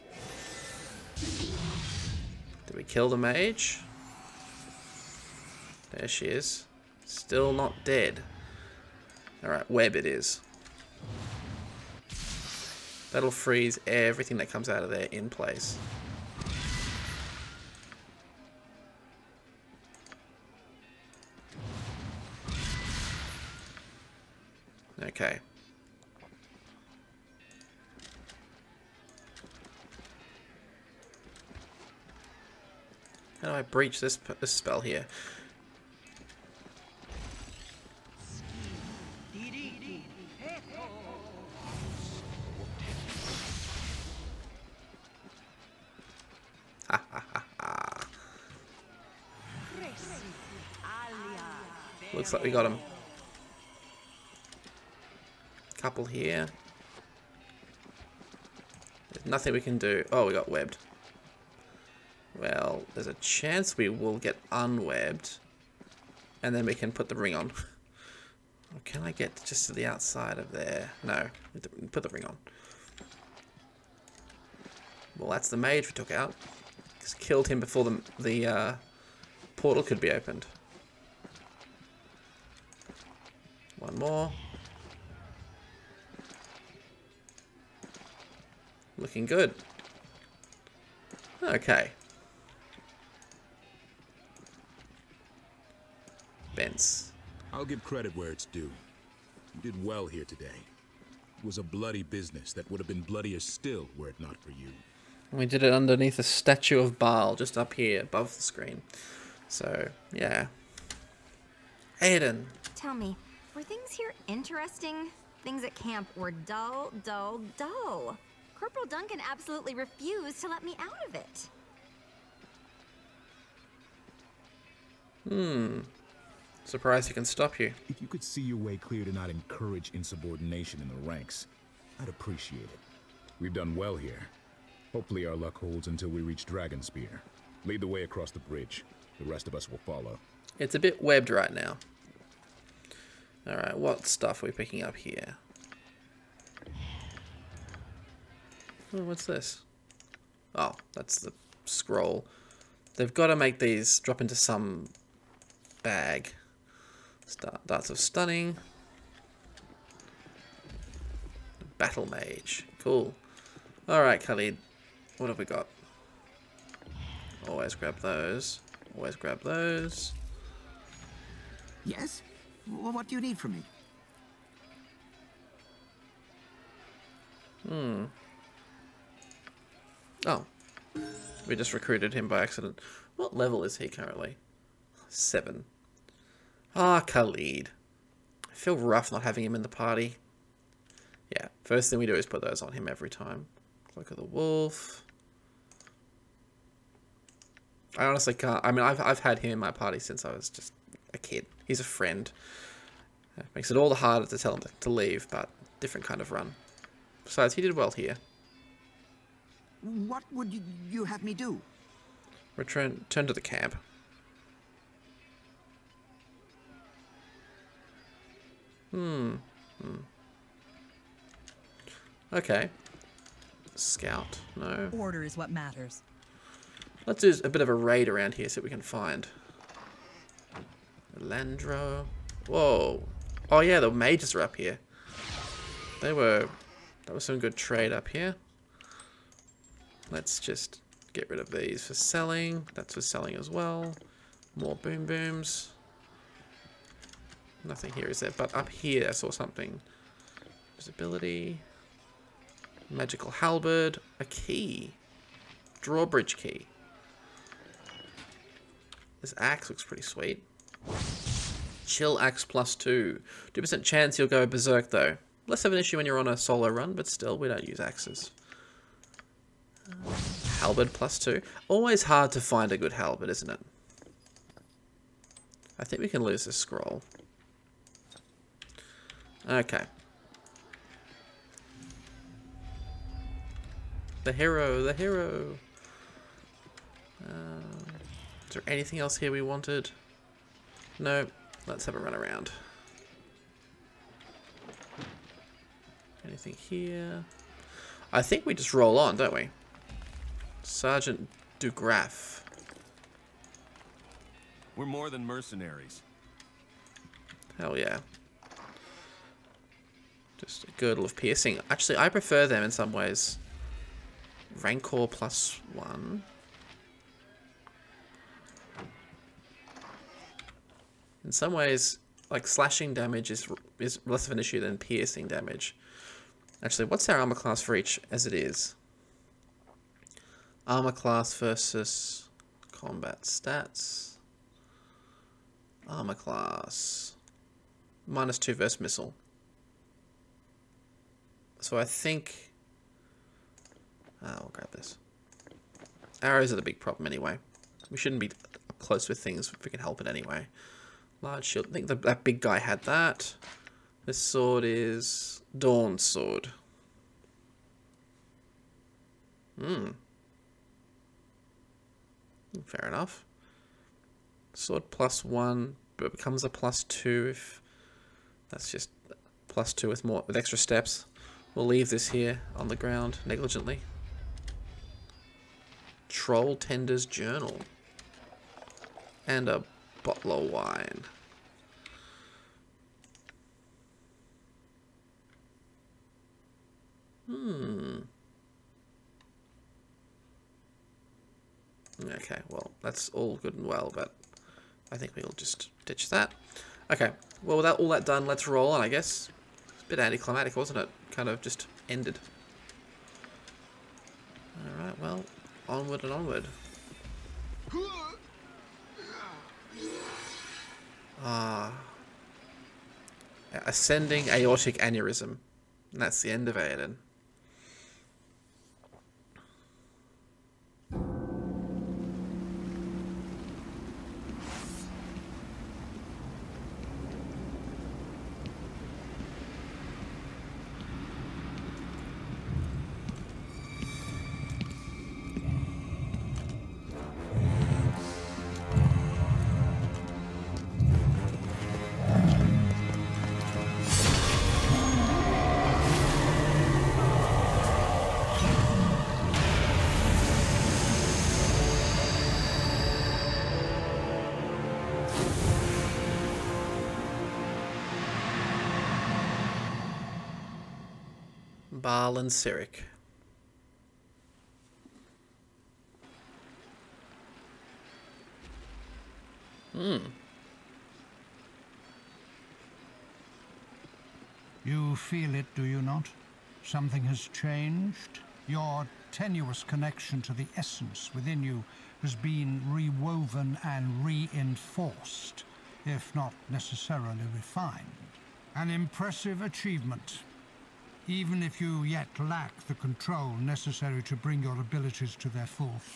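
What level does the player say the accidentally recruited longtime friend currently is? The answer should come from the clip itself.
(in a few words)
7.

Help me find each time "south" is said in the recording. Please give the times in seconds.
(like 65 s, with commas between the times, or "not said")
not said.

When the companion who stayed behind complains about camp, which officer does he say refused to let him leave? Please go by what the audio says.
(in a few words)
Corporal Duncan.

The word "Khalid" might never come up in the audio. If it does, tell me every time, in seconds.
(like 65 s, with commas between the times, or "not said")
164 s, 187 s.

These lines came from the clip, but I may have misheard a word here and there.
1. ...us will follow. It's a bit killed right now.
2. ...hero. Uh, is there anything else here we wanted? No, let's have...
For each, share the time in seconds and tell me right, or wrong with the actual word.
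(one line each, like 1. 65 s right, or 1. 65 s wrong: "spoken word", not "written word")
1. 139 s wrong: "webbed", not "killed"
2. 284 s right.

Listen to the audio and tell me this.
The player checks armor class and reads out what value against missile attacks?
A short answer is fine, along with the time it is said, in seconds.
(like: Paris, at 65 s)
Minus two, at 338 s.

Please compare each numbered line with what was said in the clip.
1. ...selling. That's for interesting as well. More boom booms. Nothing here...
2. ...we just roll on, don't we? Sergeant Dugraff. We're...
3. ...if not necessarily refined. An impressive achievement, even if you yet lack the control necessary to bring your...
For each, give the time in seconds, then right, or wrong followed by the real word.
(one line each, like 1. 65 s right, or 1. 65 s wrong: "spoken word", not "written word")
1. 241 s wrong: "selling", not "interesting"
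2. 298 s right
3. 485 s right.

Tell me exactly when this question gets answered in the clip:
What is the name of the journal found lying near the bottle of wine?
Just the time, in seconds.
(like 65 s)
376 s.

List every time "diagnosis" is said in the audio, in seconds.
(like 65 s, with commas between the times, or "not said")
not said.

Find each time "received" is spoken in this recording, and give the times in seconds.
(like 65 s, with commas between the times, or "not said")
not said.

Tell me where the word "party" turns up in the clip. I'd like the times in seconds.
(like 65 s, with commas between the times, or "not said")
189 s, 199 s.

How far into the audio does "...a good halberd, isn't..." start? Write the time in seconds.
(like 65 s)
272 s.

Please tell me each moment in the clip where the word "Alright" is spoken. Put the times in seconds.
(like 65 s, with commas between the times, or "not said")
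9 s, 143 s, 163 s, 404 s.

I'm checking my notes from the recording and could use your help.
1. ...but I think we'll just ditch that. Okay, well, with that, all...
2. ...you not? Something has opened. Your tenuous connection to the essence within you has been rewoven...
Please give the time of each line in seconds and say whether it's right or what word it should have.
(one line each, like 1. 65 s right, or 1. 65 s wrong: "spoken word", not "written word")
1. 393 s right
2. 475 s wrong: "changed", not "opened".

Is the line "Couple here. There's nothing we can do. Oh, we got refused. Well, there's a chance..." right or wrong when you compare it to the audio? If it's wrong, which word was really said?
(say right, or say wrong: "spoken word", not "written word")
wrong: "webbed", not "refused".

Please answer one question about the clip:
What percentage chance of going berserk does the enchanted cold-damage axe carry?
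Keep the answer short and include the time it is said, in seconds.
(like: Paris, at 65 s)
2%, at 263 s.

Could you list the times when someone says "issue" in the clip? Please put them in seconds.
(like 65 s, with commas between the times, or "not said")
265 s, 324 s.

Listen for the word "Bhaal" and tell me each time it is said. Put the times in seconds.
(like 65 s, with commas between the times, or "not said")
106 s, 461 s.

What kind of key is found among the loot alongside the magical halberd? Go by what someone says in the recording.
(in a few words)
Drawbridge key.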